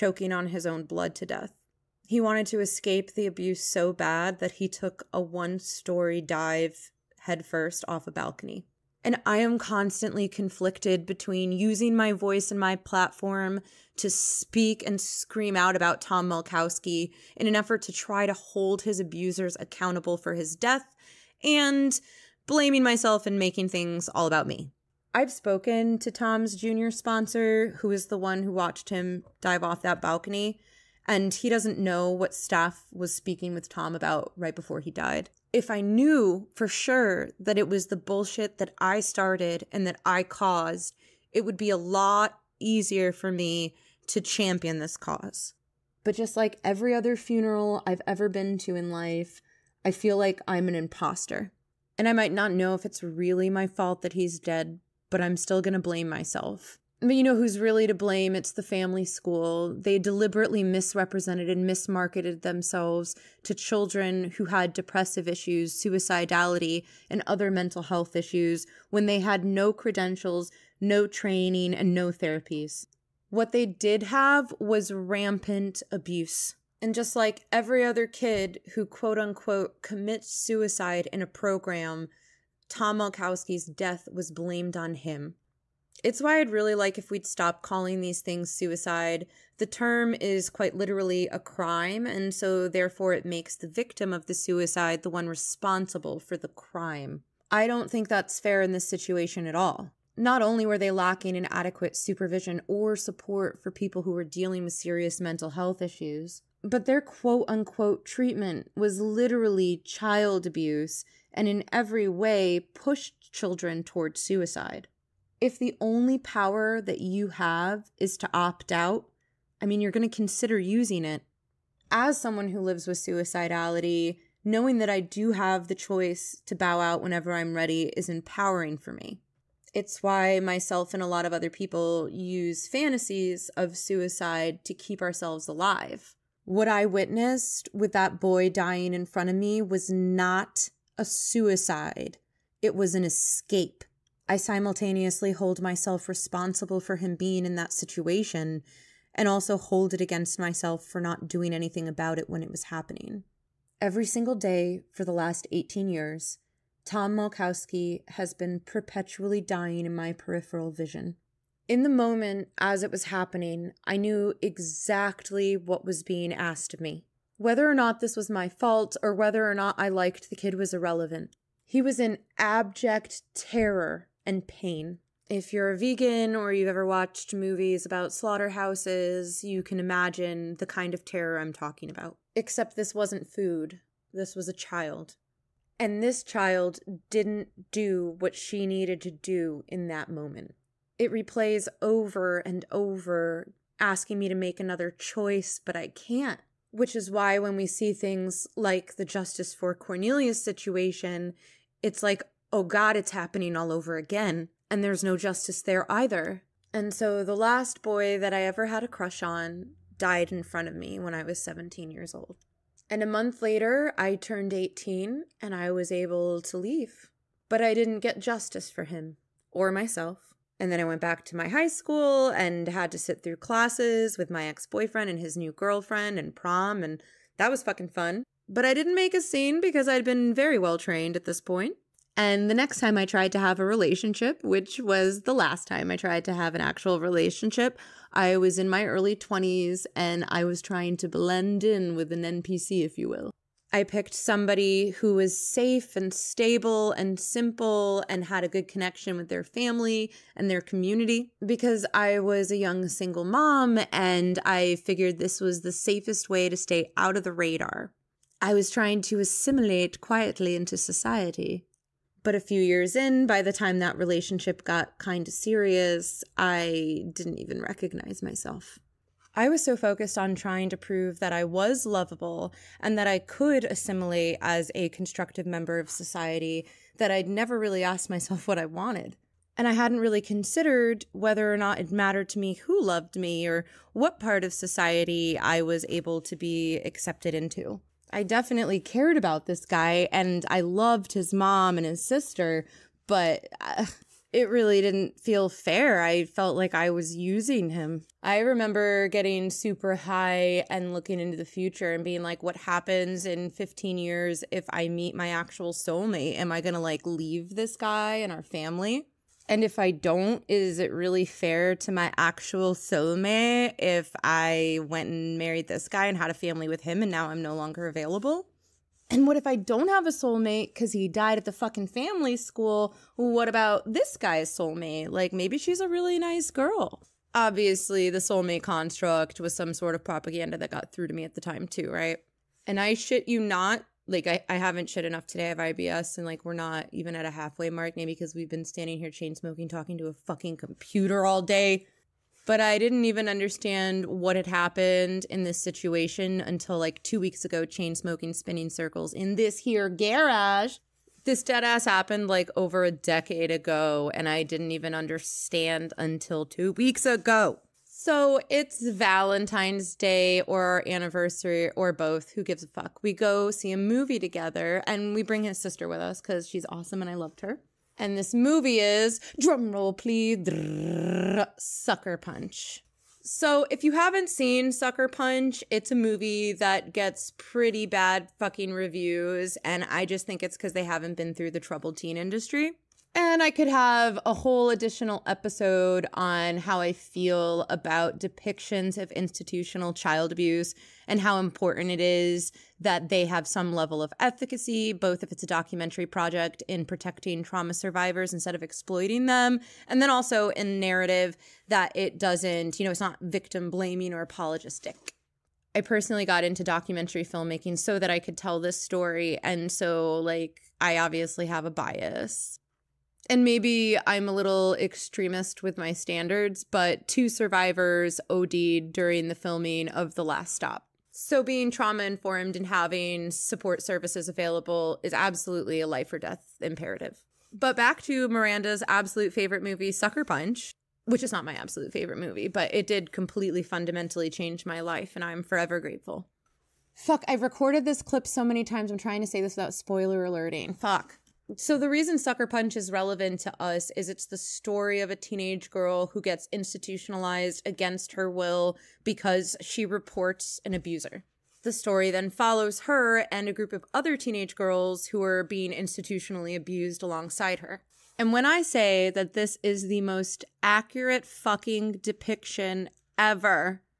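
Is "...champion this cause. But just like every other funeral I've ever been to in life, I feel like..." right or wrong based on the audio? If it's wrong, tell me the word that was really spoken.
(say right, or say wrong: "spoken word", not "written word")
right.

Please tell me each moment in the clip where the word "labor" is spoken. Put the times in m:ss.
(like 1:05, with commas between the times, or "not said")
not said.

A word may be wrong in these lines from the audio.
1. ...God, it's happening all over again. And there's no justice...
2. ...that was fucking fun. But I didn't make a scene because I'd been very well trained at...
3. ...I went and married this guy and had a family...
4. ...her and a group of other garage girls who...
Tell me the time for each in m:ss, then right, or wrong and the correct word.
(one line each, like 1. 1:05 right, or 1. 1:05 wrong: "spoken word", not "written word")
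1. 3:22 right
2. 3:47 right
3. 5:14 right
4. 7:32 wrong: "teenage", not "garage".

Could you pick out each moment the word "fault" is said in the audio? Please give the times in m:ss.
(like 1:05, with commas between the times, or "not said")
0:53, 2:48.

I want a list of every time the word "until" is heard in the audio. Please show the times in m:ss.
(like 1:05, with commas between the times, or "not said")
5:46, 5:55.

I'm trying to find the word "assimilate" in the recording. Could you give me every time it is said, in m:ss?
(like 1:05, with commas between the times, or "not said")
4:19, 4:33.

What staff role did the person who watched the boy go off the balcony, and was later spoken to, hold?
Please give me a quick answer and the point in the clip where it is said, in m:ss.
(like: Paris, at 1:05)
Junior sponsor, at 0:26.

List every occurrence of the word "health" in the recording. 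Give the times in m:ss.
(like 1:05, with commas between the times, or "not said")
1:07, 1:45.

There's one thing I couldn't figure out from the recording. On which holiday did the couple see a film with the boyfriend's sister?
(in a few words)
Valentine's Day.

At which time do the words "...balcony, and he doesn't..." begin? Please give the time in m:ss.
0:30.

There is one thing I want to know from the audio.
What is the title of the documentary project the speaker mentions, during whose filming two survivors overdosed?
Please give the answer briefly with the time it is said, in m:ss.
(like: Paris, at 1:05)
The Last Stop, at 7:00.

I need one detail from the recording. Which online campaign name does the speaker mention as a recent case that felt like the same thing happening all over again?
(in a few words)
Justice for Cornelius.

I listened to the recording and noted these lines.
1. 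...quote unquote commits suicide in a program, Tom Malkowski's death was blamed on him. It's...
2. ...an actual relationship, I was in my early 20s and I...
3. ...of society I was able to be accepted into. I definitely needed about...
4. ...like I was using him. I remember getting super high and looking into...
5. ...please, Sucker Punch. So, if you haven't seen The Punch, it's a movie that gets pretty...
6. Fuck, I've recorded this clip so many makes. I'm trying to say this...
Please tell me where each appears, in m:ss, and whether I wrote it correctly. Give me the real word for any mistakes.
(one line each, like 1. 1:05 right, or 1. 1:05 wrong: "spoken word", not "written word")
1. 1:18 right
2. 3:56 right
3. 4:44 wrong: "cared", not "needed"
4. 4:56 right
5. 6:09 wrong: "Sucker", not "The"
6. 7:16 wrong: "times", not "makes".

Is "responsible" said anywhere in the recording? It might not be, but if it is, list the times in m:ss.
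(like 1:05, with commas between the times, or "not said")
1:35, 2:26.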